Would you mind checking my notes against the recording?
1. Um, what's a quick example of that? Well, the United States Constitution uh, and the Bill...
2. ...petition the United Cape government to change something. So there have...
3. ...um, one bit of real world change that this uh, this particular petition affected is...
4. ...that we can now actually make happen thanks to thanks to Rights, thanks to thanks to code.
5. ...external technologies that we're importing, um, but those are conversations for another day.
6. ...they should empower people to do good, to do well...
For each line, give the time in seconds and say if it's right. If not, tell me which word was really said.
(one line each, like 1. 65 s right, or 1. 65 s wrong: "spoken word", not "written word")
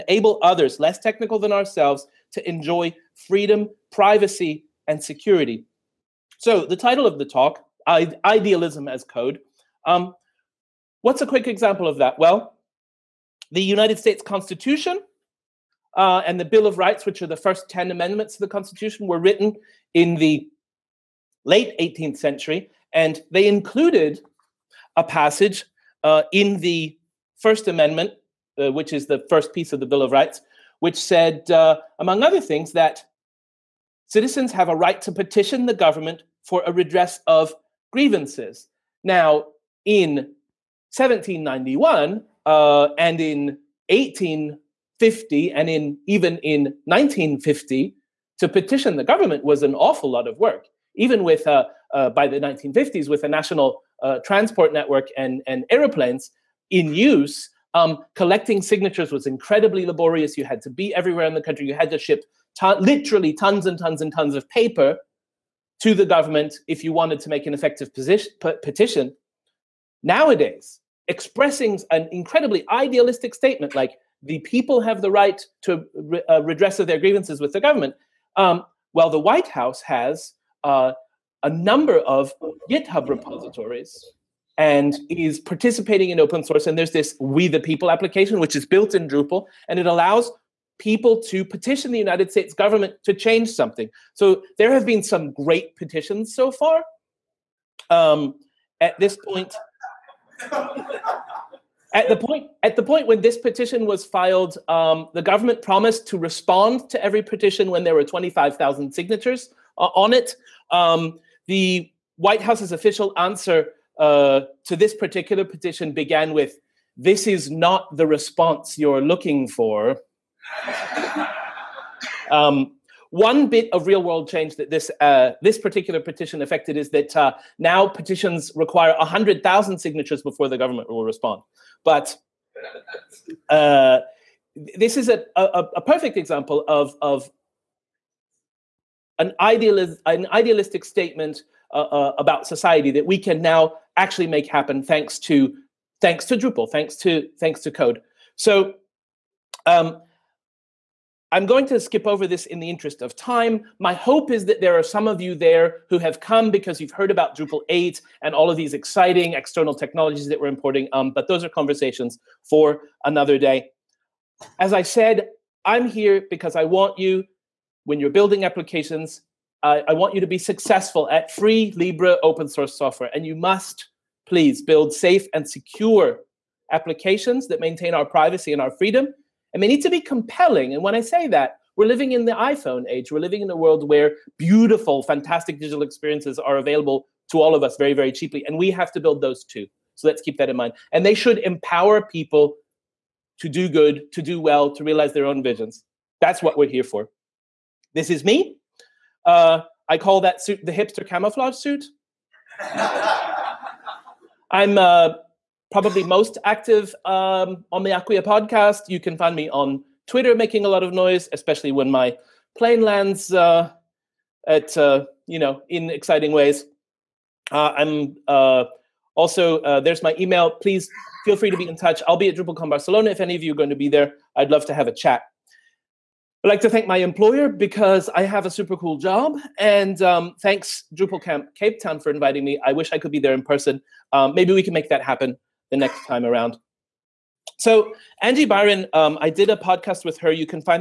1. 9 s right
2. 91 s wrong: "States", not "Cape"
3. 122 s right
4. 142 s wrong: "Drupal", not "Rights"
5. 159 s right
6. 191 s right.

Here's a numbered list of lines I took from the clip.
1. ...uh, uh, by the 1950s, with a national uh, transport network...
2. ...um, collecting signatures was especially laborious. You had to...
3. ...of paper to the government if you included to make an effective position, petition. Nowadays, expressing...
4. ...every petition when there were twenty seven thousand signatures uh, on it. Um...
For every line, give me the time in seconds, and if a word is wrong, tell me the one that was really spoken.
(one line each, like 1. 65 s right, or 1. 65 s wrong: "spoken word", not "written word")
1. 51 s right
2. 57 s wrong: "incredibly", not "especially"
3. 64 s wrong: "wanted", not "included"
4. 107 s wrong: "five", not "seven".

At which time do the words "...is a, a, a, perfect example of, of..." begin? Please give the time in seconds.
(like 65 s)
134 s.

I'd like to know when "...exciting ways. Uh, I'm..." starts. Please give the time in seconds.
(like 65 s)
215 s.